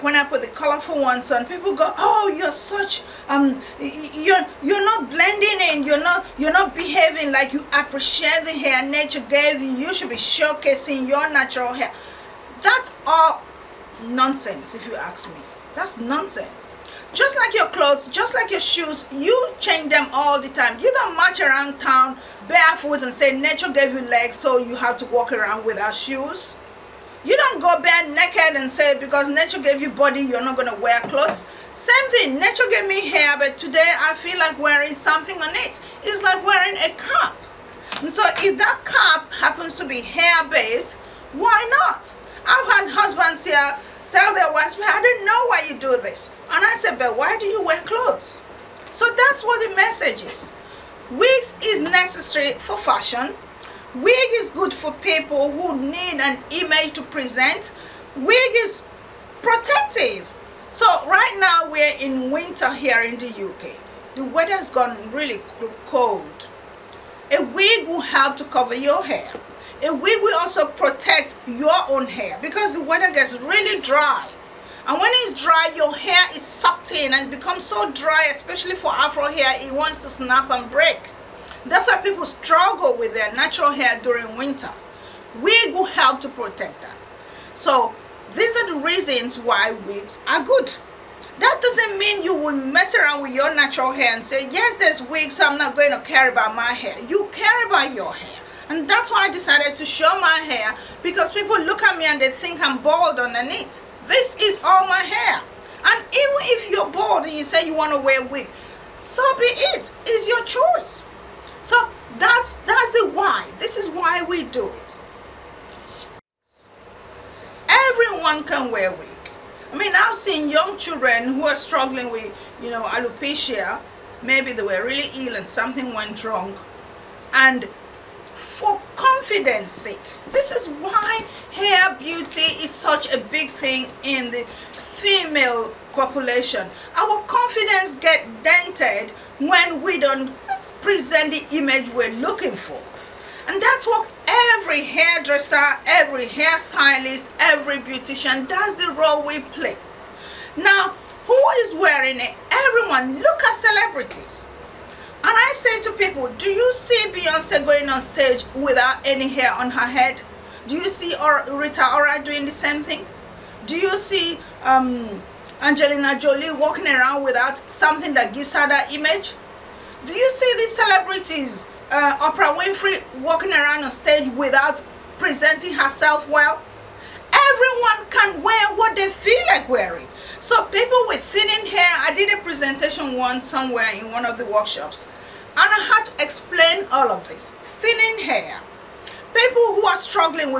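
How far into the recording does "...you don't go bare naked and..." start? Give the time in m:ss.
0:27.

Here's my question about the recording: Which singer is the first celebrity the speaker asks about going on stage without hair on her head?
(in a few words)
Beyonce.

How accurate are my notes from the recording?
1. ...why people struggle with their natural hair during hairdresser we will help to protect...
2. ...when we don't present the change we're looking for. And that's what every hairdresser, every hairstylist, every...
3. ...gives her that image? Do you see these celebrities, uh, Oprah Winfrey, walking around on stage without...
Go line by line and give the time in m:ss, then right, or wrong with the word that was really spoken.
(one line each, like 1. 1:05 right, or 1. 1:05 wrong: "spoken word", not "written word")
1. 1:21 wrong: "winter", not "hairdresser"
2. 2:19 wrong: "image", not "change"
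3. 2:48 right.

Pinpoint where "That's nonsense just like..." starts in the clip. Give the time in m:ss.
0:15.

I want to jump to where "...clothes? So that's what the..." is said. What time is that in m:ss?
0:47.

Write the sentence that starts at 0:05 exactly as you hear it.
You're not you're not behaving like you appreciate the hair nature gave you.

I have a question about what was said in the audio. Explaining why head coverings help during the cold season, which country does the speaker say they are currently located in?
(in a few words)
UK.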